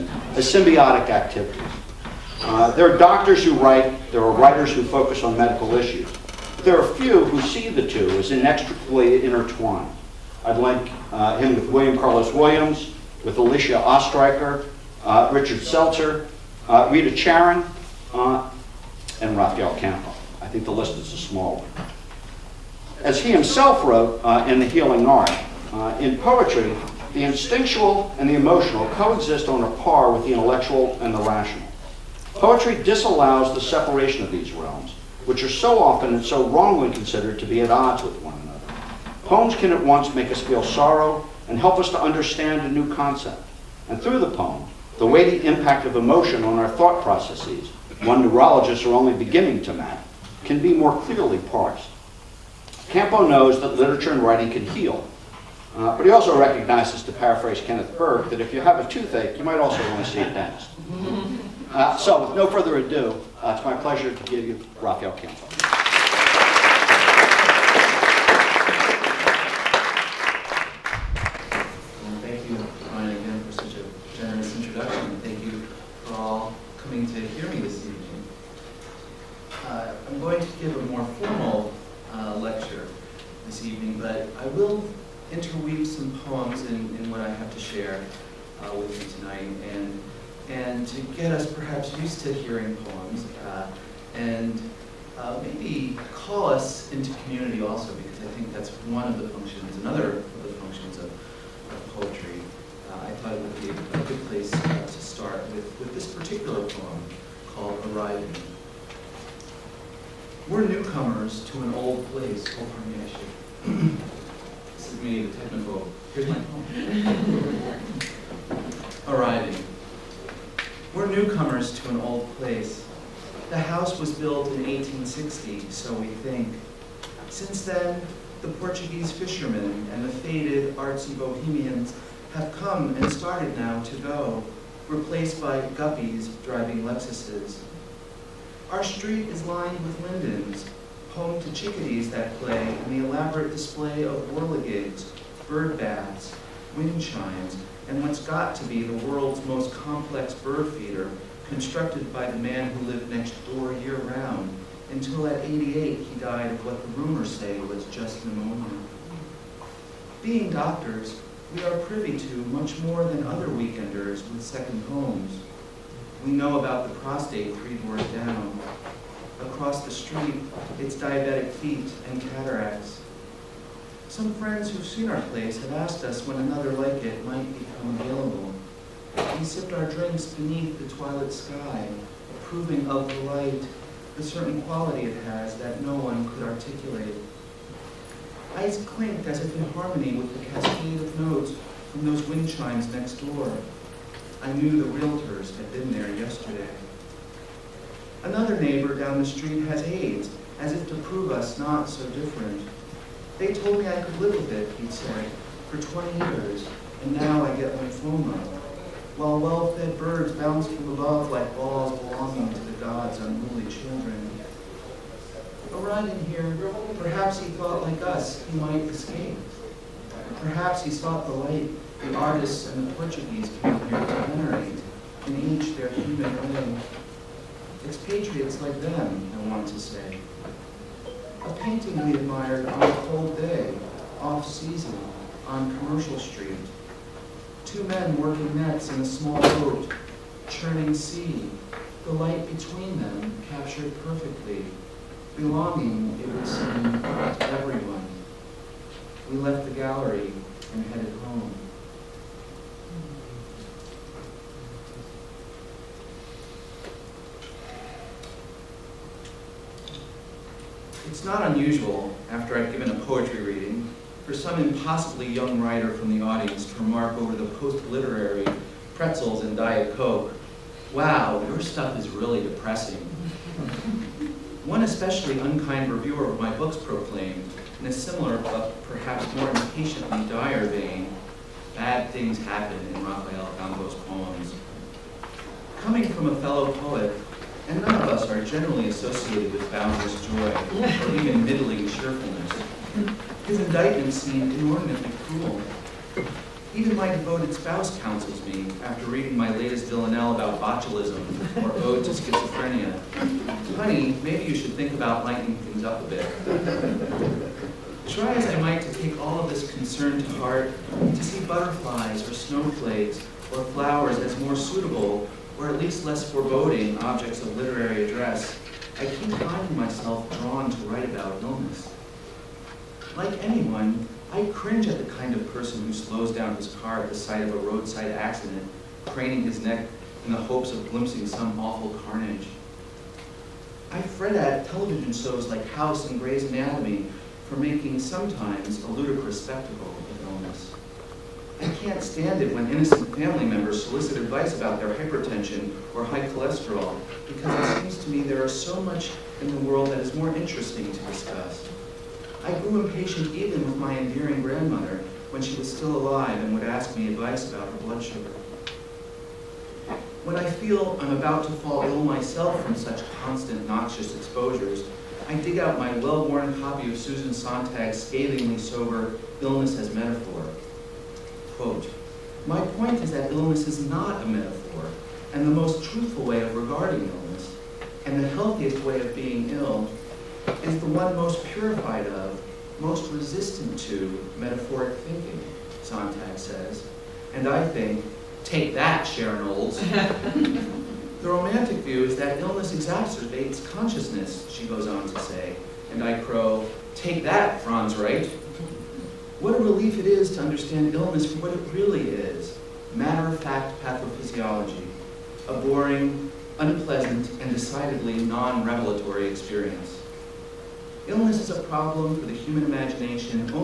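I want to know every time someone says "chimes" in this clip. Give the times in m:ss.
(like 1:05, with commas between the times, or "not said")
2:27, 3:12.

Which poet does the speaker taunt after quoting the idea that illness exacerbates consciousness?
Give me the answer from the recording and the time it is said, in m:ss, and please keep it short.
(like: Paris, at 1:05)
Franz Wright, at 6:37.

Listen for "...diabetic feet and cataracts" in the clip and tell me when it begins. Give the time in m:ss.
2:50.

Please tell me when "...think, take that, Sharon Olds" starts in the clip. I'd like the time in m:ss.
6:27.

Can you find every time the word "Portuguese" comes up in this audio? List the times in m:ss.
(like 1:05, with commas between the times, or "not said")
2:08, 3:42.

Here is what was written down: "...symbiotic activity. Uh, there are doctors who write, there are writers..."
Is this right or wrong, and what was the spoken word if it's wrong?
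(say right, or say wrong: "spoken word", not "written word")
right.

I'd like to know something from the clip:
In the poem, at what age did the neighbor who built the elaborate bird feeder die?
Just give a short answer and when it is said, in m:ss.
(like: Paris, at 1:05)
88, at 2:35.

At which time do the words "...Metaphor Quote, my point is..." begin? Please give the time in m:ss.
6:09.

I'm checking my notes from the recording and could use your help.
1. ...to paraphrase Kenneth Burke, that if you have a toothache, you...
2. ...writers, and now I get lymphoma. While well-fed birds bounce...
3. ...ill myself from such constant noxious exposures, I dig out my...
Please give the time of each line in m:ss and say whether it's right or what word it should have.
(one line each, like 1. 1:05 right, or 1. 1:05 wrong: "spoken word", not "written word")
1. 0:57 right
2. 3:26 wrong: "years", not "writers"
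3. 6:01 right.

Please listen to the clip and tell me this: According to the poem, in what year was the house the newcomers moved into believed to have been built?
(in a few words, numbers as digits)
1860.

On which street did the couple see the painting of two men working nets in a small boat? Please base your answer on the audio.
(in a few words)
Commercial Street.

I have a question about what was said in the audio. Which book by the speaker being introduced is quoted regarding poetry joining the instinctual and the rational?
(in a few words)
The Healing Art.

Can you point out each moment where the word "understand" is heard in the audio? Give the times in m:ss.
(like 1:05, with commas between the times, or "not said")
0:42, 6:40.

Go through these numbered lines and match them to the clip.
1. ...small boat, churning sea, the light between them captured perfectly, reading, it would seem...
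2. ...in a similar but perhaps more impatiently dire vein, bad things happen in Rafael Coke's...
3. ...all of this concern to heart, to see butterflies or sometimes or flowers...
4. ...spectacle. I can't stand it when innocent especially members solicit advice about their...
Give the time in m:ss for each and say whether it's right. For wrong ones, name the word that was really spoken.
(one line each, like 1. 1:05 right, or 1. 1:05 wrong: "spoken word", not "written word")
1. 3:59 wrong: "belonging", not "reading"
2. 4:37 wrong: "Campo", not "Coke"
3. 5:09 wrong: "snowflakes", not "sometimes"
4. 5:39 wrong: "family", not "especially".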